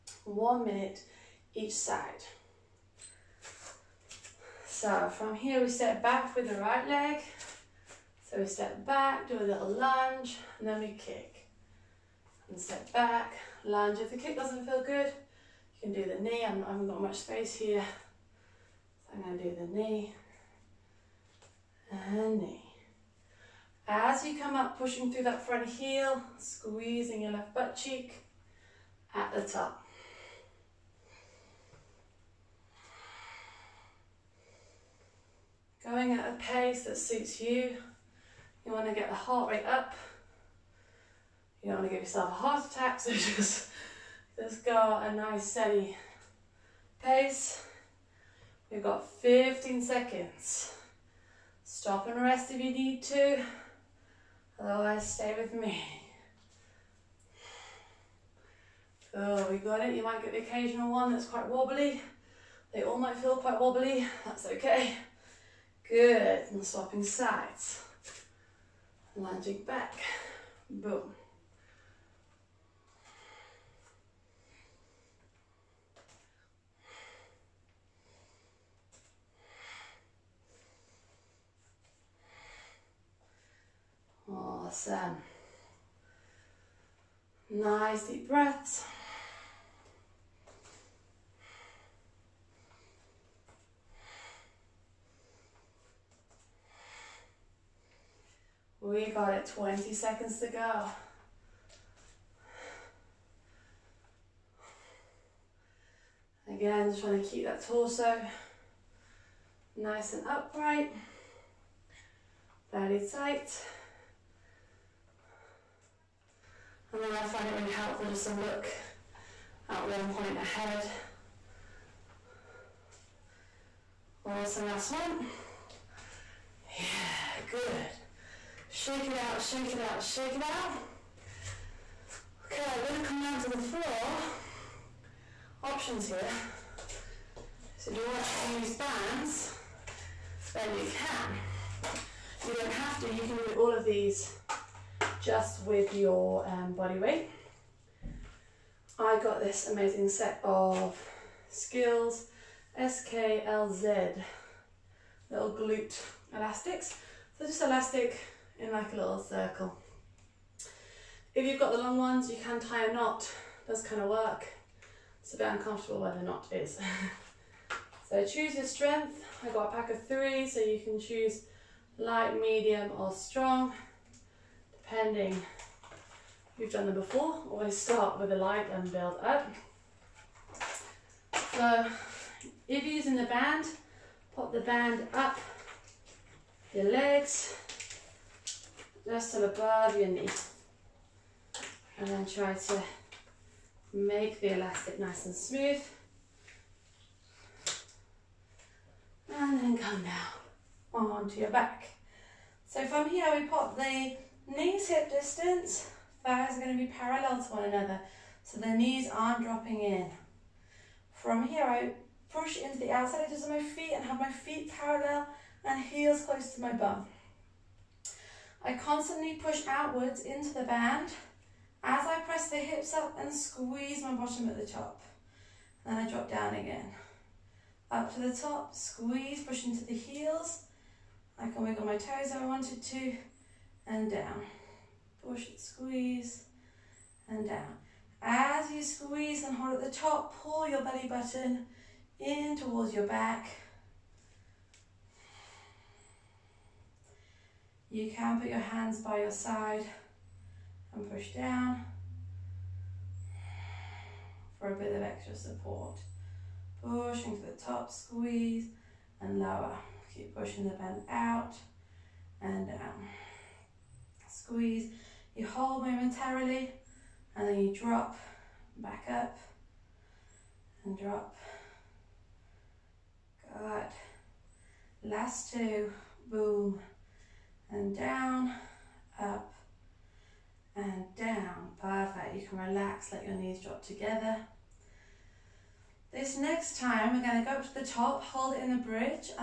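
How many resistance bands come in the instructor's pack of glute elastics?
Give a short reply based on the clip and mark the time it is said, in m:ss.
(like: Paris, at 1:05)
3, at 2:50.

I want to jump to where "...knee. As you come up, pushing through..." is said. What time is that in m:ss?
0:22.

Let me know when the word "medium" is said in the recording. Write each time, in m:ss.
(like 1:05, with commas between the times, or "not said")
2:52.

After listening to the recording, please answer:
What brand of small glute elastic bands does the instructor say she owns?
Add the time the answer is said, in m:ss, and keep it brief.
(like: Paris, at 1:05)
SKLZ, at 2:31.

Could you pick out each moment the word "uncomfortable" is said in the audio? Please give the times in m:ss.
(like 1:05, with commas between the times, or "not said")
2:45.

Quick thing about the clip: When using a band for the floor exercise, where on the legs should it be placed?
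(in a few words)
Just above your knee.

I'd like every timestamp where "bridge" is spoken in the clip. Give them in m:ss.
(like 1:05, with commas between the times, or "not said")
4:48.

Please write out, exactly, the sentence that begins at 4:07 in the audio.
You can put your hands by your side and push down for a bit of extra support.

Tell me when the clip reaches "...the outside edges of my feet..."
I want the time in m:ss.
3:32.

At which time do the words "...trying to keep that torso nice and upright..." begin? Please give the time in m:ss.
1:47.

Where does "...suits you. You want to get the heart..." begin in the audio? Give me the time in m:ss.
0:36.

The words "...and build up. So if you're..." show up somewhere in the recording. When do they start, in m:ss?
2:58.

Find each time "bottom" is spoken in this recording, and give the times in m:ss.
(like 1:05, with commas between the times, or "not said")
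3:44.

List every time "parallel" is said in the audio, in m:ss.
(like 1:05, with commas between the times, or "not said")
3:26, 3:34.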